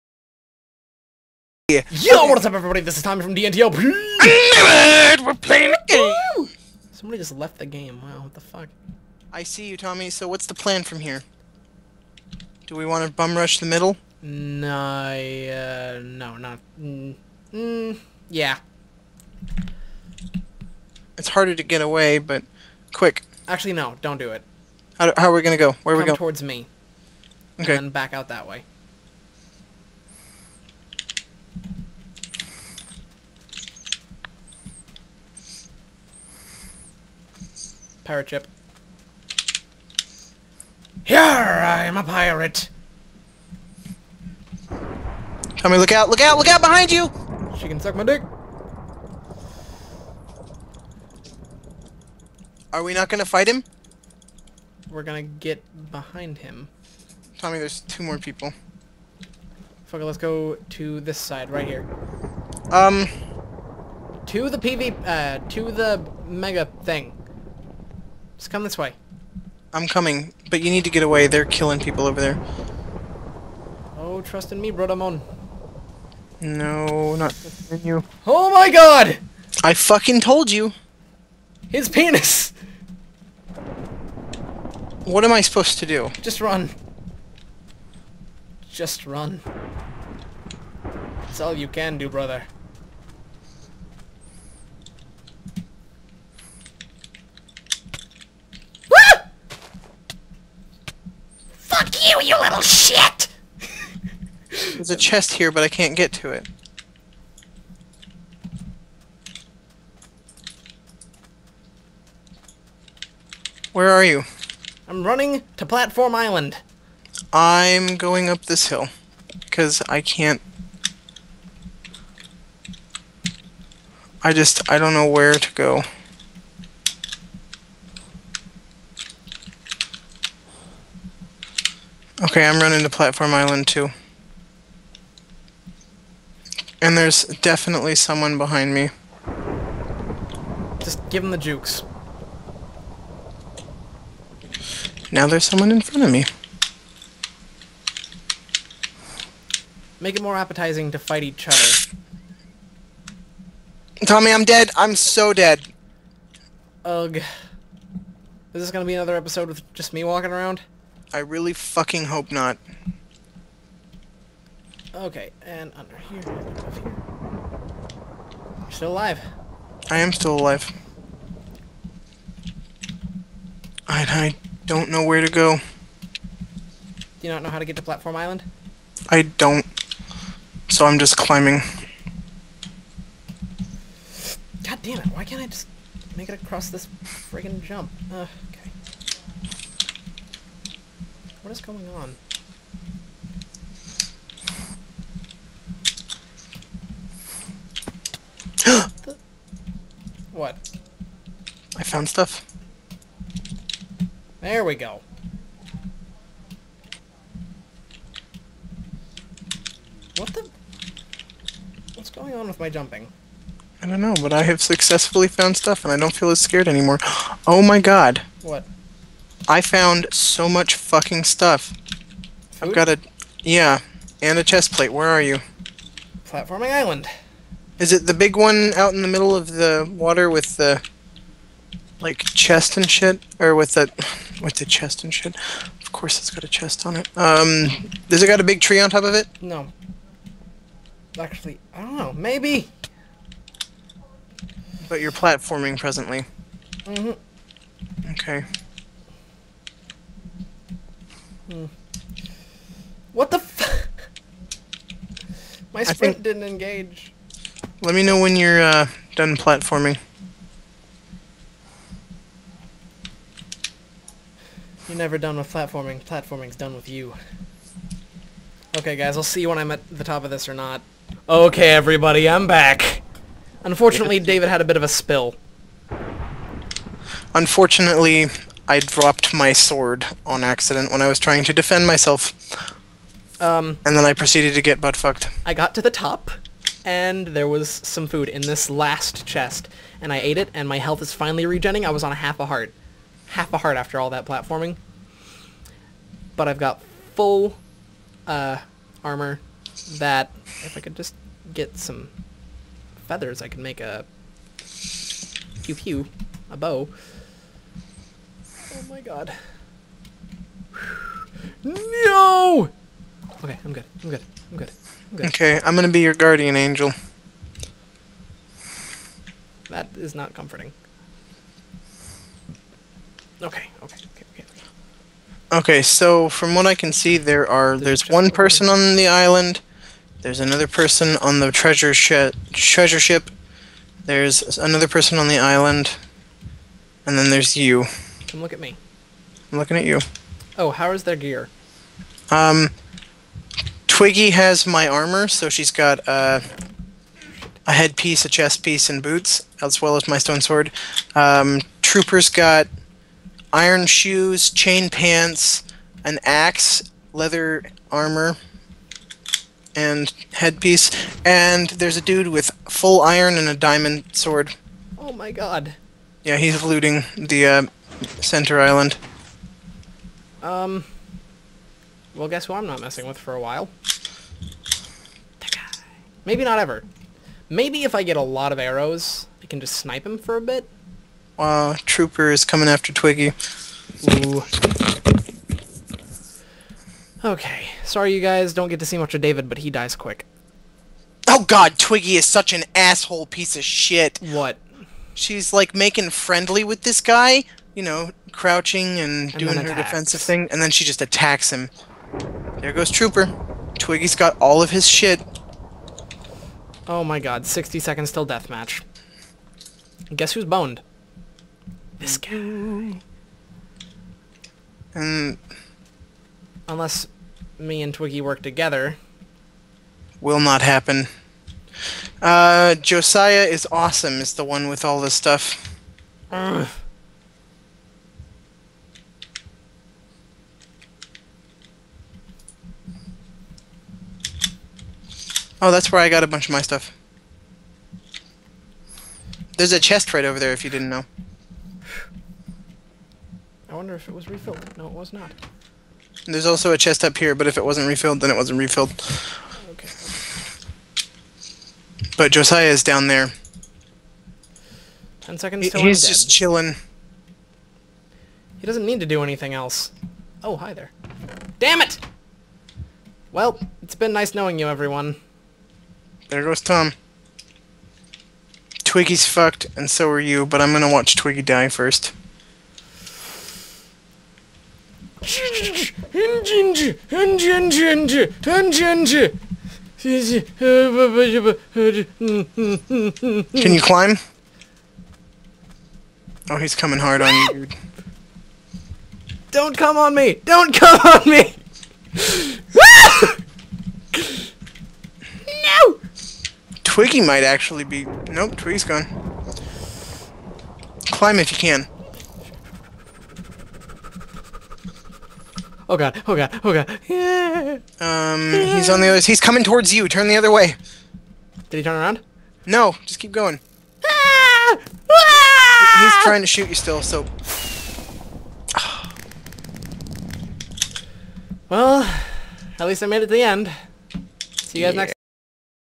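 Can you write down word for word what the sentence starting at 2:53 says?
I, I don't know where to go.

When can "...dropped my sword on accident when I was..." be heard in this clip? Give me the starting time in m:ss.
4:38.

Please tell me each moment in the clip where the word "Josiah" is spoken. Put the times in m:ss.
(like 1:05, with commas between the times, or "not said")
7:02, 7:32.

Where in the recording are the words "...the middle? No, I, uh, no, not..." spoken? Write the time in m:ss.
0:13.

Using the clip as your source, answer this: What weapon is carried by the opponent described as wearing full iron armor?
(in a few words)
Diamond sword.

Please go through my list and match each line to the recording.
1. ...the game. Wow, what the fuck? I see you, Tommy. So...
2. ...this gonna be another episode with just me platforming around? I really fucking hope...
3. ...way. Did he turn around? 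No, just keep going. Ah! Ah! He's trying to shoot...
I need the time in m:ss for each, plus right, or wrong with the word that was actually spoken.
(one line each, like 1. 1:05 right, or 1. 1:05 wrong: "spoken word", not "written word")
1. 0:07 right
2. 2:38 wrong: "walking", not "platforming"
3. 8:30 right.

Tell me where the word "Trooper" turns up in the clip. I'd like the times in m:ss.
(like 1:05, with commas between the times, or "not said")
5:51, 6:21, 6:42.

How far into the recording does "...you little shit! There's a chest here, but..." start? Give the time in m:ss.
1:42.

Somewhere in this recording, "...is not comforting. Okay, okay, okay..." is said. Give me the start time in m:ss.
5:19.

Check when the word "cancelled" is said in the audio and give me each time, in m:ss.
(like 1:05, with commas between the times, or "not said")
not said.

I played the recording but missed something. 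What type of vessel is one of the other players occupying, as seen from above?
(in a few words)
Treasure ship.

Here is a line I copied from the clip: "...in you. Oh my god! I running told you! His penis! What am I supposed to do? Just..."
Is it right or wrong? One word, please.
wrong.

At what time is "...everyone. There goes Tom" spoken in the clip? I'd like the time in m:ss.
7:44.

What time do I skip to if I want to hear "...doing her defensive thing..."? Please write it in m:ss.
6:39.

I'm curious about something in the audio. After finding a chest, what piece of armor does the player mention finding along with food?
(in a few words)
A chest plate.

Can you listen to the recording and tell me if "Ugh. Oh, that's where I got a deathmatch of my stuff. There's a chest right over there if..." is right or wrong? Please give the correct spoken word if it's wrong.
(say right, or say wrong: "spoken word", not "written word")
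wrong: "bunch", not "deathmatch".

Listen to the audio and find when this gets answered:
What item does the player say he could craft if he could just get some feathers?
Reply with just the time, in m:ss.
5:06.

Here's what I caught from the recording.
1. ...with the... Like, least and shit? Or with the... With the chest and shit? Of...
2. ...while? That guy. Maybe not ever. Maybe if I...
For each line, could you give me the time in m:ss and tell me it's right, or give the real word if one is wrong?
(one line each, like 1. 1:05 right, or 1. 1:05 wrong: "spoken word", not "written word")
1. 3:50 wrong: "chest", not "least"
2. 6:13 right.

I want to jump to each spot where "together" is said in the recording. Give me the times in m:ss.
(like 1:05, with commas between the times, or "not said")
6:58.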